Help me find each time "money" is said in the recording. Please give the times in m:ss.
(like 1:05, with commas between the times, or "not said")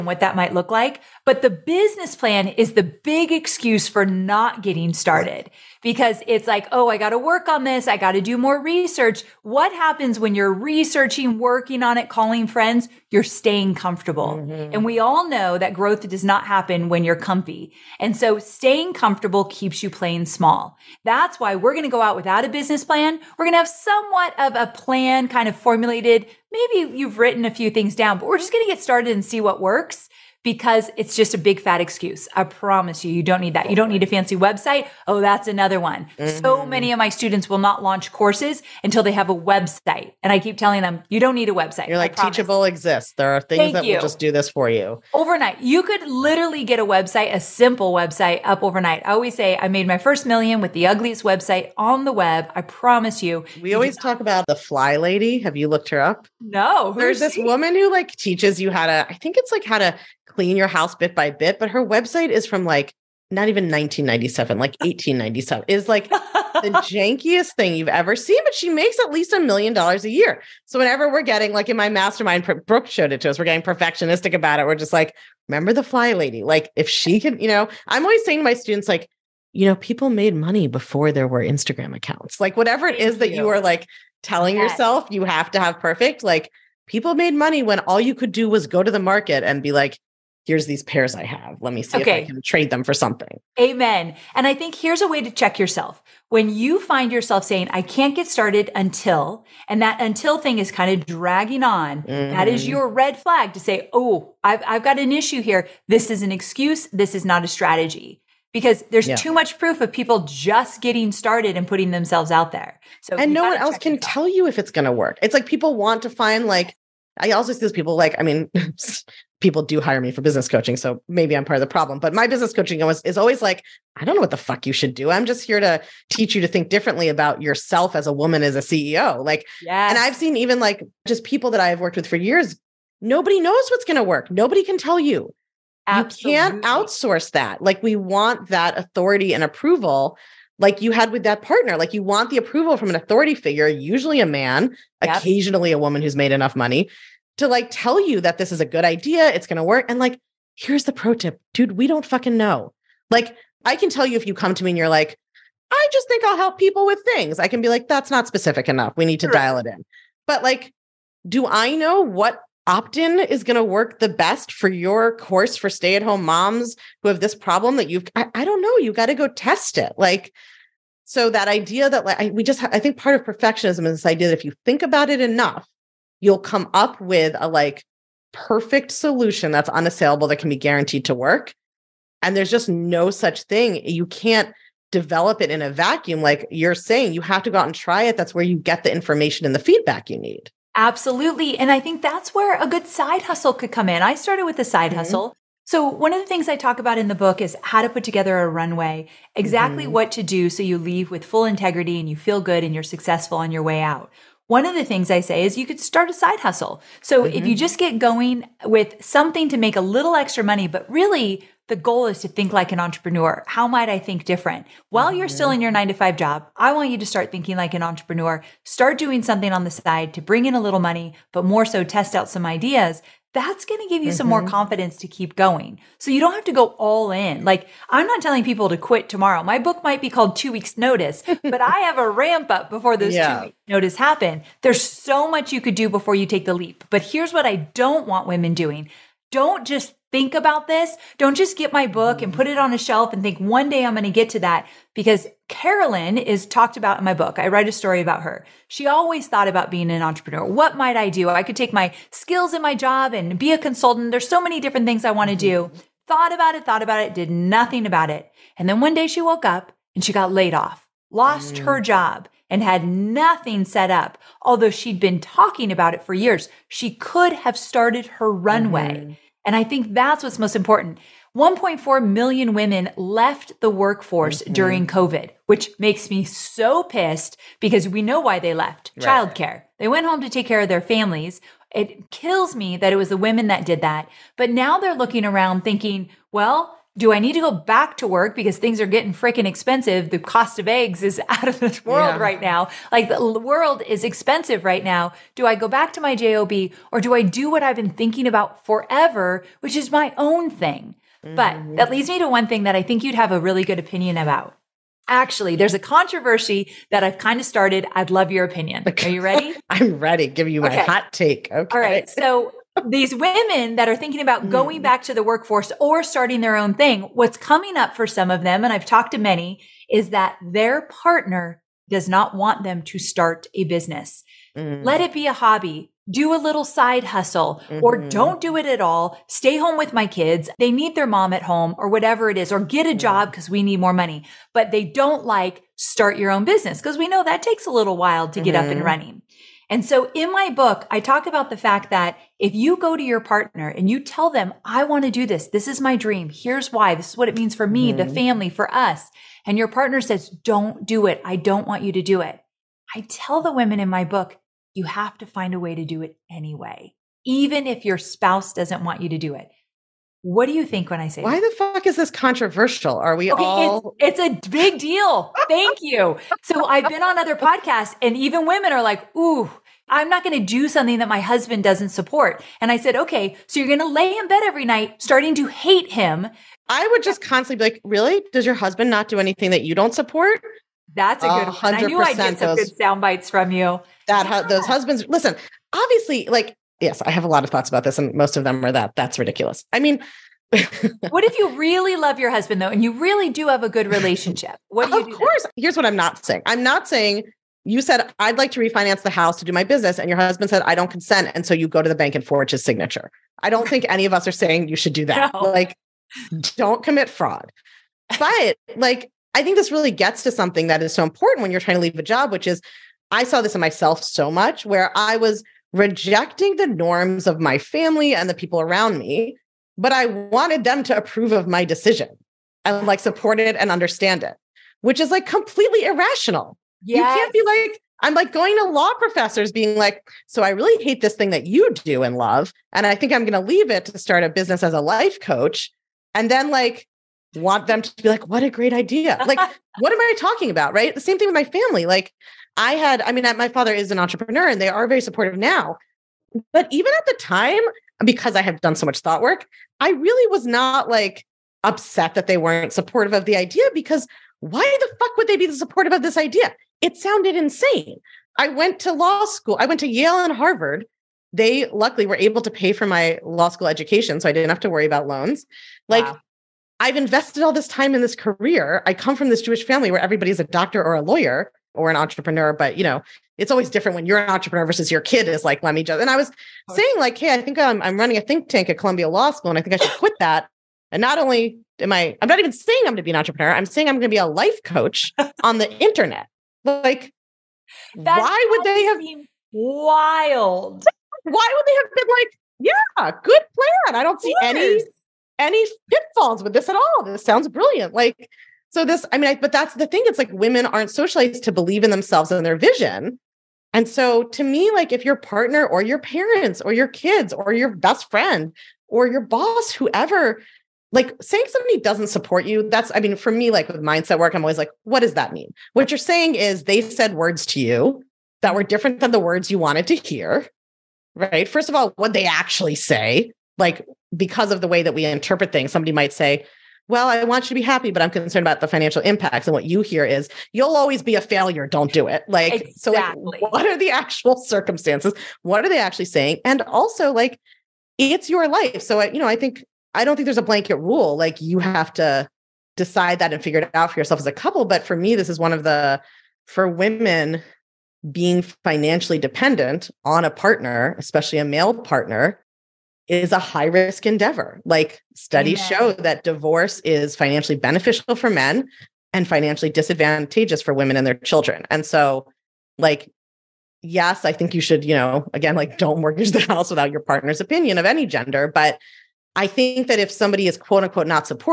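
1:20, 1:27, 2:26, 3:30, 3:40, 5:33.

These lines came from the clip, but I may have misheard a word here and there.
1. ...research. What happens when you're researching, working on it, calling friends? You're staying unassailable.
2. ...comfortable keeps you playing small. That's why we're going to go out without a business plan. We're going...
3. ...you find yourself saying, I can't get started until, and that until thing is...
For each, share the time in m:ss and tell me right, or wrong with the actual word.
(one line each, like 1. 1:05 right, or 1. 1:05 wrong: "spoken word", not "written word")
1. 0:08 wrong: "comfortable", not "unassailable"
2. 0:18 right
3. 1:36 right.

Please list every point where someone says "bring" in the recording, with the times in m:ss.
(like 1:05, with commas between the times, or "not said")
3:40.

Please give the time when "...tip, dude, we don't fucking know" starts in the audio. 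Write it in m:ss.
2:31.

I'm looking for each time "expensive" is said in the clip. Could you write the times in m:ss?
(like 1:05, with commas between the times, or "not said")
4:49, 4:54.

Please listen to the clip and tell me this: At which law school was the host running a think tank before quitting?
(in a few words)
Columbia Law School.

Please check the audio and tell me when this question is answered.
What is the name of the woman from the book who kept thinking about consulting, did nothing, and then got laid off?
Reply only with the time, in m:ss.
4:05.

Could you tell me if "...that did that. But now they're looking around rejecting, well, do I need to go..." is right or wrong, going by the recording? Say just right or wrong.
wrong.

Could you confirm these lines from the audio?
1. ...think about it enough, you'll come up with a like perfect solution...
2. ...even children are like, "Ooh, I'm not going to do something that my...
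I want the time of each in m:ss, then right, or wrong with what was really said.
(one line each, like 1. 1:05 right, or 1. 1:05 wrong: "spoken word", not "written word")
1. 2:54 right
2. 6:08 wrong: "women", not "children".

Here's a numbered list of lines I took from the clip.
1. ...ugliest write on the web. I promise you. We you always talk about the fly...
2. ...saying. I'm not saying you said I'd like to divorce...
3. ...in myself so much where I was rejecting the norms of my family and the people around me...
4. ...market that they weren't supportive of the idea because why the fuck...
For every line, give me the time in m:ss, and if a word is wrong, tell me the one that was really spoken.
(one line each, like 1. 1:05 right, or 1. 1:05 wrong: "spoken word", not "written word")
1. 0:50 wrong: "website", not "write"
2. 6:36 wrong: "refinance", not "divorce"
3. 6:53 right
4. 7:31 wrong: "upset", not "market".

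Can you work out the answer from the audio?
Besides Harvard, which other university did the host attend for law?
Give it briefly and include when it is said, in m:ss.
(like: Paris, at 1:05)
Yale, at 7:39.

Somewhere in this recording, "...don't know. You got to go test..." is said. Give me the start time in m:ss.
2:48.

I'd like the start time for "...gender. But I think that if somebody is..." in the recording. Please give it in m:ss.
9:28.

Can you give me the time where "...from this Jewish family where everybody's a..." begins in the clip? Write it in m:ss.
7:49.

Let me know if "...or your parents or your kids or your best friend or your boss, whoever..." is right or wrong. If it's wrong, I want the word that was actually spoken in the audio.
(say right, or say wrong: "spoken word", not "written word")
right.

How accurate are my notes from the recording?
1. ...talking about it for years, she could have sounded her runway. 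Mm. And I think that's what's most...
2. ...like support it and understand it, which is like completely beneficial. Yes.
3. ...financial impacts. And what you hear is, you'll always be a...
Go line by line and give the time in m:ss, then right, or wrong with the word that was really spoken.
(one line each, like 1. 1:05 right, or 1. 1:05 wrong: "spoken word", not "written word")
1. 4:25 wrong: "started", not "sounded"
2. 7:02 wrong: "irrational", not "beneficial"
3. 8:48 right.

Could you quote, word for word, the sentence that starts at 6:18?
Does your husband not do anything that you don't support?" That's a good uh, one.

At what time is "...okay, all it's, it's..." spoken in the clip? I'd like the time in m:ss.
6:03.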